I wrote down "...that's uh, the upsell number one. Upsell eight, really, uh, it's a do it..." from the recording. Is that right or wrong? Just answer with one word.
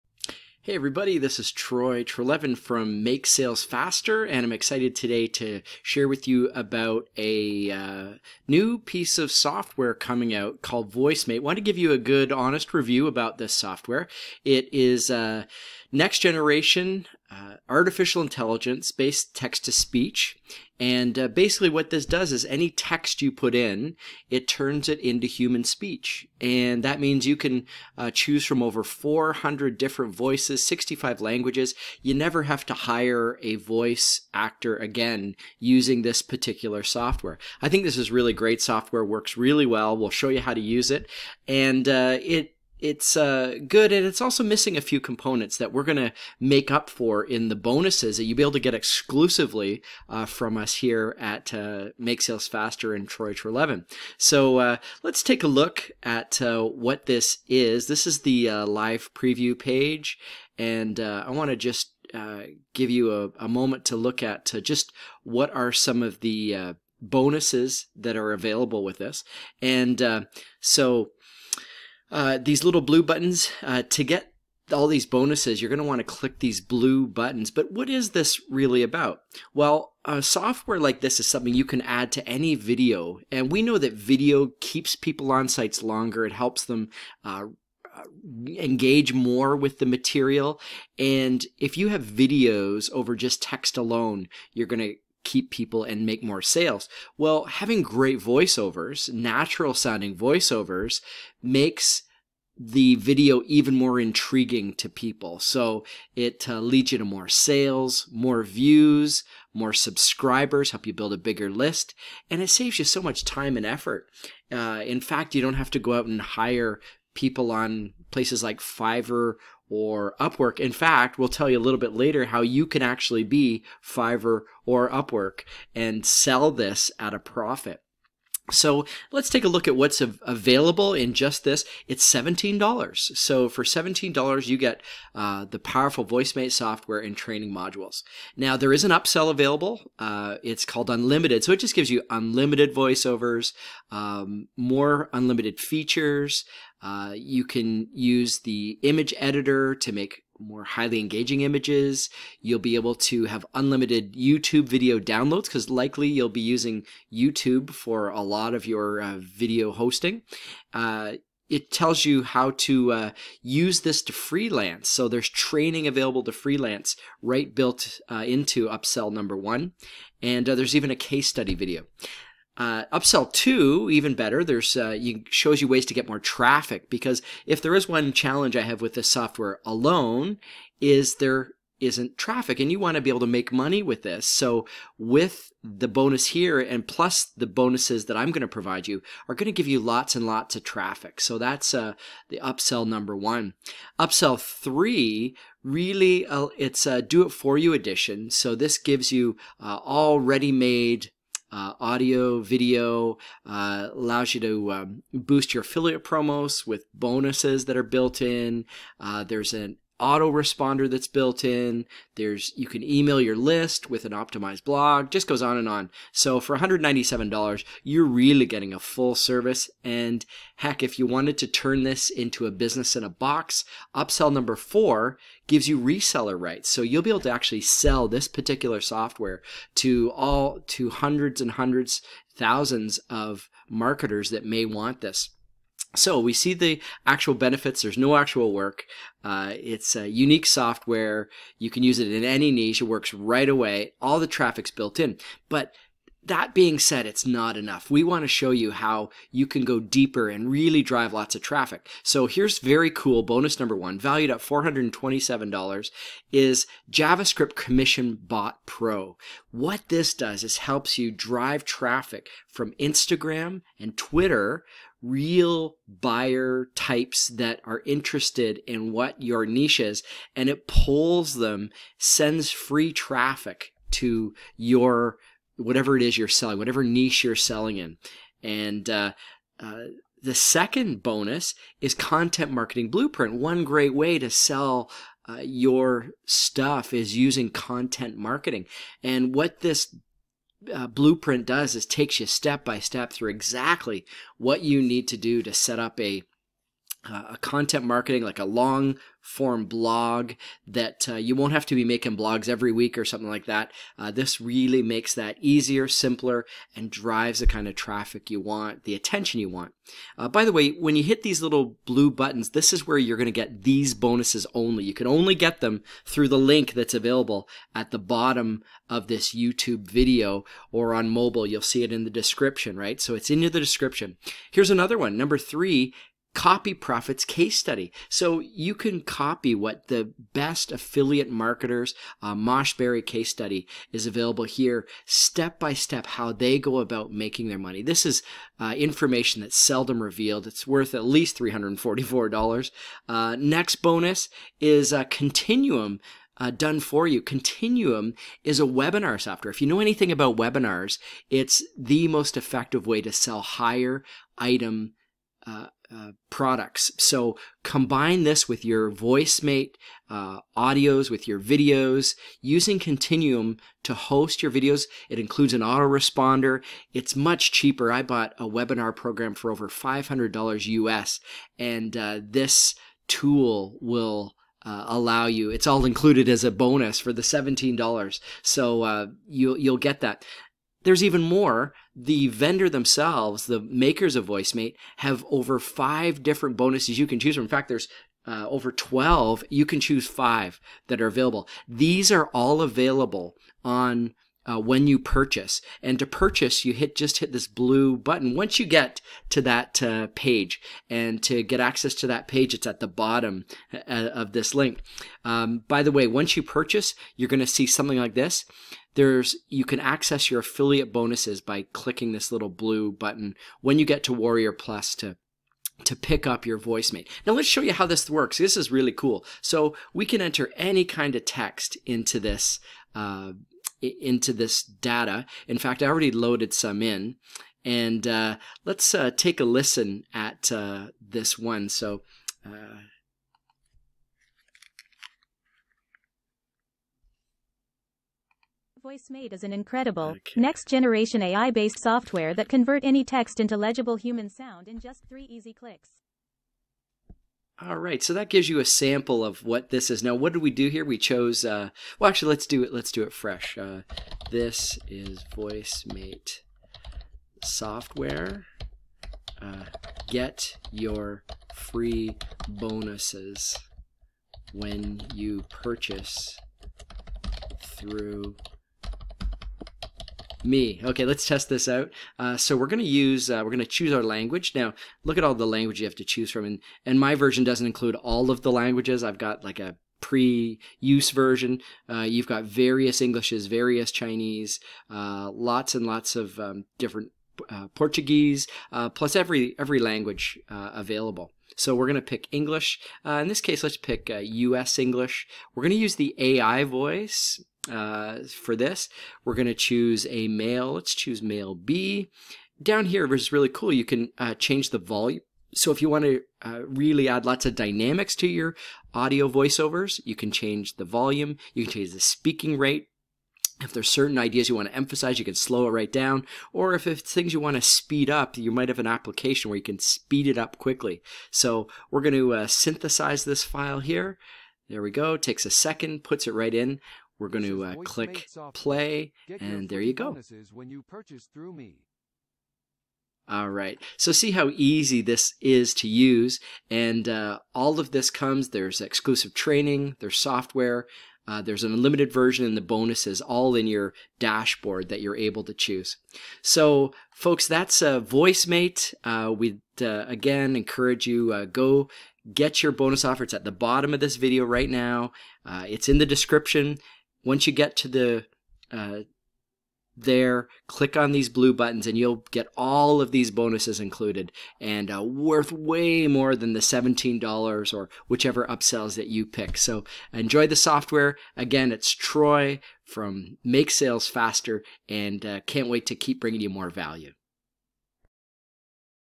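wrong.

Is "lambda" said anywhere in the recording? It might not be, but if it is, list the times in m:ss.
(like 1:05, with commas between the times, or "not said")
not said.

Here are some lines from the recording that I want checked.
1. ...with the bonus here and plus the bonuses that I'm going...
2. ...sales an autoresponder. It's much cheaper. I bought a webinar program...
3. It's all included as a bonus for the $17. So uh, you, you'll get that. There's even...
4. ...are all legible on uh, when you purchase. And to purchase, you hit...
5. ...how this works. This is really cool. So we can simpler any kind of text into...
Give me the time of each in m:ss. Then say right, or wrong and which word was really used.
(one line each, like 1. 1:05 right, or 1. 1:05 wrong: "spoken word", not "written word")
1. 3:04 right
2. 6:05 wrong: "includes", not "sales"
3. 6:15 right
4. 6:32 wrong: "available", not "legible"
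5. 6:57 wrong: "enter", not "simpler".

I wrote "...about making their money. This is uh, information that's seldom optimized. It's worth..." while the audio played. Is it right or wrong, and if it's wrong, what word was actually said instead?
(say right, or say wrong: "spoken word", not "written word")
wrong: "revealed", not "optimized".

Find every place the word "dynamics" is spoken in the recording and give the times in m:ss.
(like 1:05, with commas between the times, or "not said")
8:27.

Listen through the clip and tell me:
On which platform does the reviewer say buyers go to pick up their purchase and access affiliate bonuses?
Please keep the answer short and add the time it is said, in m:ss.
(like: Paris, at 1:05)
Warrior Plus, at 6:54.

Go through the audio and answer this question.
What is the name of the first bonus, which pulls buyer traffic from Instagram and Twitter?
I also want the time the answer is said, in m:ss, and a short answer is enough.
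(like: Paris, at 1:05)
JavaScript Commission Bot Pro, at 4:16.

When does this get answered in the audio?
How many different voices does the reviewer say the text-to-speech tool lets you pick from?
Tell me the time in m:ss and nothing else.
0:28.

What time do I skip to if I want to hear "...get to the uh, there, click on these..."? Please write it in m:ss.
9:17.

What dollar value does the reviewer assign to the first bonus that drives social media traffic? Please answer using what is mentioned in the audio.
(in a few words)
$427.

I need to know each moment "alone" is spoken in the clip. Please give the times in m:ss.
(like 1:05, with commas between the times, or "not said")
1:33, 2:59.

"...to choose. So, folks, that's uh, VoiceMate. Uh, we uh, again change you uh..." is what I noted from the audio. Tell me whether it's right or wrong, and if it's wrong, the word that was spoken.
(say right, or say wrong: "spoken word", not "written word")
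wrong: "encourage", not "change".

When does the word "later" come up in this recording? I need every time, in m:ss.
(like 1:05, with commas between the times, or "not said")
2:01.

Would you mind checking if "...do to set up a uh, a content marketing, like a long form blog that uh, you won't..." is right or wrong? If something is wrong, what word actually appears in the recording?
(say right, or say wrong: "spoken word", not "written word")
right.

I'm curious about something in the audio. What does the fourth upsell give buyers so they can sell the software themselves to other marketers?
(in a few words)
reseller rights.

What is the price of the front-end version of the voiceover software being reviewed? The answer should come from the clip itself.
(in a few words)
$17.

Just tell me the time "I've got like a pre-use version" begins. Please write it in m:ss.
7:59.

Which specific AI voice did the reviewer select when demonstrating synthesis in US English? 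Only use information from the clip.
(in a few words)
male B.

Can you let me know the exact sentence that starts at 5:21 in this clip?
You'll see it in the description, right?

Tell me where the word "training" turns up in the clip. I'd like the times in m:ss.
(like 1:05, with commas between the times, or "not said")
2:17, 2:45, 8:59.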